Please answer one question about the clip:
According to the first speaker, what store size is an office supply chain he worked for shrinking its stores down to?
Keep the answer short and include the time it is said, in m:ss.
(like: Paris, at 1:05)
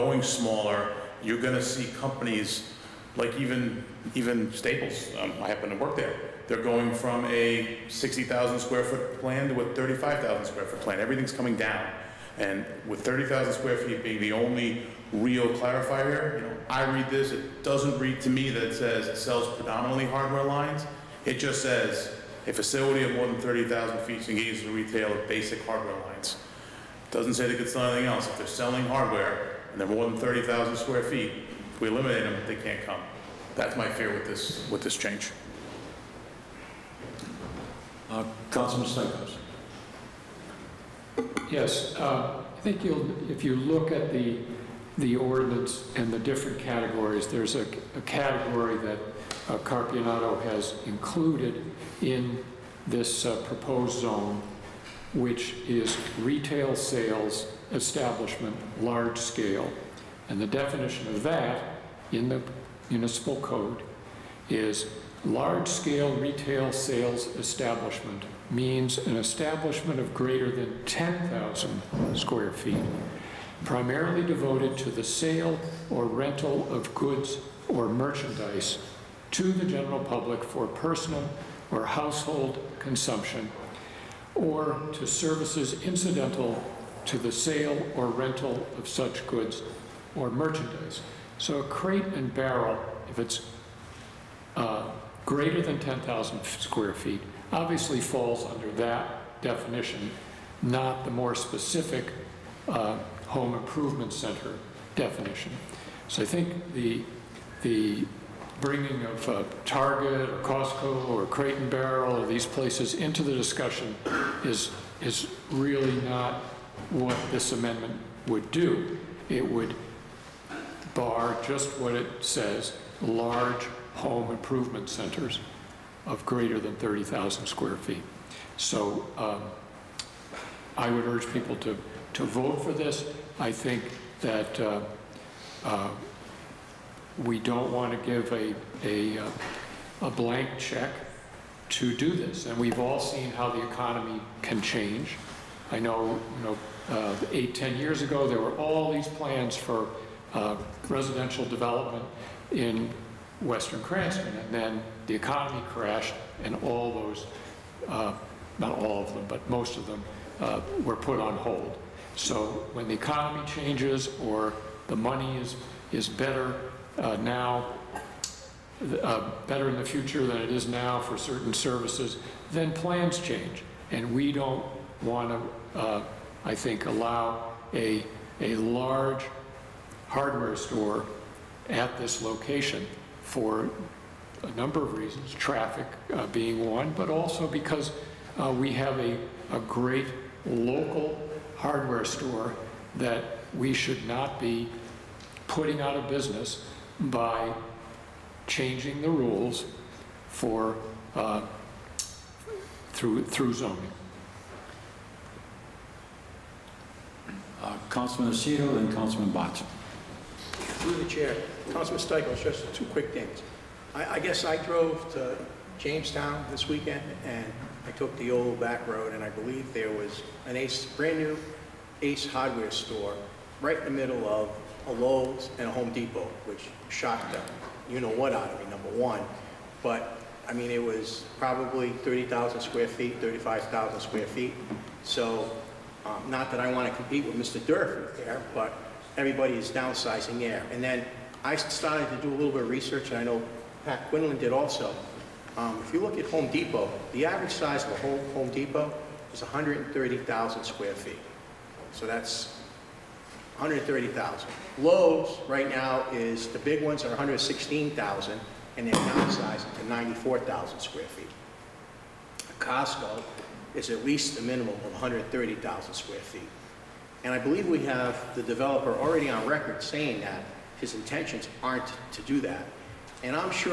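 35,000 square feet, at 0:09.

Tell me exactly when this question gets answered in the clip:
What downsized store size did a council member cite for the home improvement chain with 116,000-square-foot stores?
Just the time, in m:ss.
4:19.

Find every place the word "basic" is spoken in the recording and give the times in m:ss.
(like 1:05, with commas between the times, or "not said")
0:25.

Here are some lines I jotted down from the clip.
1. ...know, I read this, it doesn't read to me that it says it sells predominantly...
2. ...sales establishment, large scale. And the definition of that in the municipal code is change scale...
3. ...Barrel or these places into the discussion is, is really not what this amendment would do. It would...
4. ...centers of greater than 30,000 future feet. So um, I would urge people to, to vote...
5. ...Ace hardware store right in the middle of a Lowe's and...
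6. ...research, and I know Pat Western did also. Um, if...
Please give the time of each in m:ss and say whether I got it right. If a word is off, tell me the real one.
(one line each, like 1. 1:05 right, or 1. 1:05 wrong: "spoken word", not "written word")
1. 0:16 right
2. 0:56 wrong: "large", not "change"
3. 1:51 right
4. 2:04 wrong: "square", not "future"
5. 3:42 right
6. 4:02 wrong: "Quinlan", not "Western".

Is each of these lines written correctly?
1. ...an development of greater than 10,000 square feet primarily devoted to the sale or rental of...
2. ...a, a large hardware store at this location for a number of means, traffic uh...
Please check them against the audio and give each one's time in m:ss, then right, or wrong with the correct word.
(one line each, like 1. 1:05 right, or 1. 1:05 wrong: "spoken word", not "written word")
1. 1:08 wrong: "establishment", not "development"
2. 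2:57 wrong: "reasons", not "means".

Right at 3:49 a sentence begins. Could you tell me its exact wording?
But I mean, it was probably 30,000 square feet, 35,000 square feet.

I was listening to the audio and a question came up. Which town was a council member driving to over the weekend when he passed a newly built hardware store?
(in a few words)
Jamestown.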